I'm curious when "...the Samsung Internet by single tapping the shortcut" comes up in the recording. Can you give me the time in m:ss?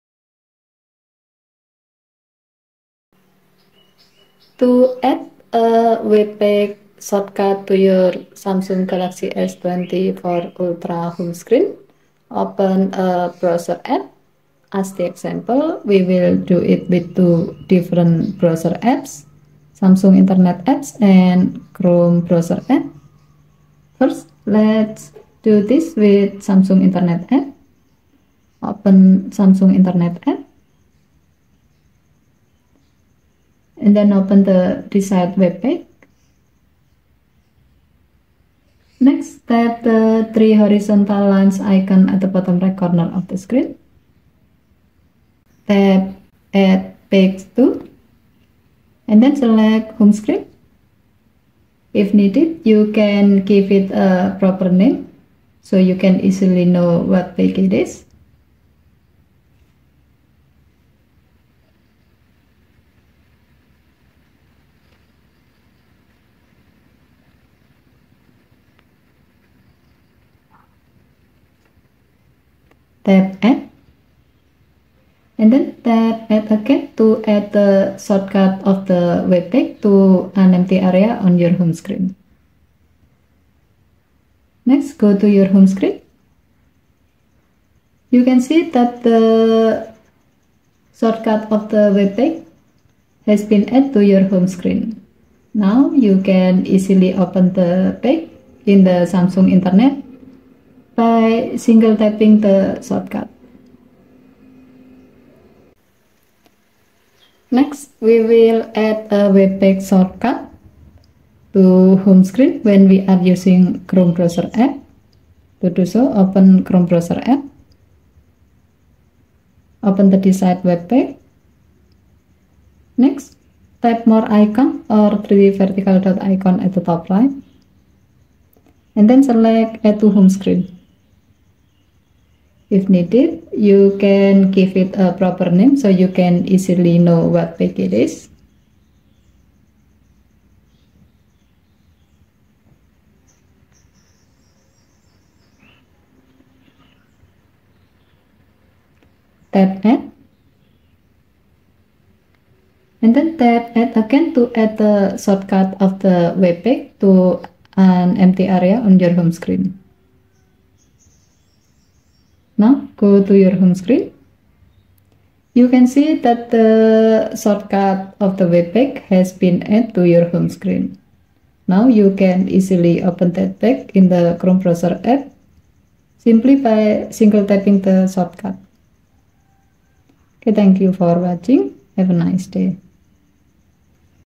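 1:38.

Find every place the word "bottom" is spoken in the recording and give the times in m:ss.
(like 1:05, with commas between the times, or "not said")
0:42.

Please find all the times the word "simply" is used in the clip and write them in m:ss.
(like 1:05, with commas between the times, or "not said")
2:56.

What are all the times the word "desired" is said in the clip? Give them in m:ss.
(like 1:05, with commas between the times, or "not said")
0:34, 2:00.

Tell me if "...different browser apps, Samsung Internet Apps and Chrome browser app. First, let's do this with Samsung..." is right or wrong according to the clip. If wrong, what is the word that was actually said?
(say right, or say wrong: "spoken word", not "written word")
right.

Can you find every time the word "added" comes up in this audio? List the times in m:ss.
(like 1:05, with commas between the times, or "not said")
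1:33, 2:49.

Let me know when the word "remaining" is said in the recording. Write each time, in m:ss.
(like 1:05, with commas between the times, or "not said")
not said.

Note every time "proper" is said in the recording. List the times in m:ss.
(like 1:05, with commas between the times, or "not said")
0:54, 2:15.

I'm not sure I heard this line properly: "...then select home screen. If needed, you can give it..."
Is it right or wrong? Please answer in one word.
right.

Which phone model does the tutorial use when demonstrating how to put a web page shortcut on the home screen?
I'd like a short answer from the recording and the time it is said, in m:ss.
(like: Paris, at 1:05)
Samsung Galaxy S24 Ultra, at 0:08.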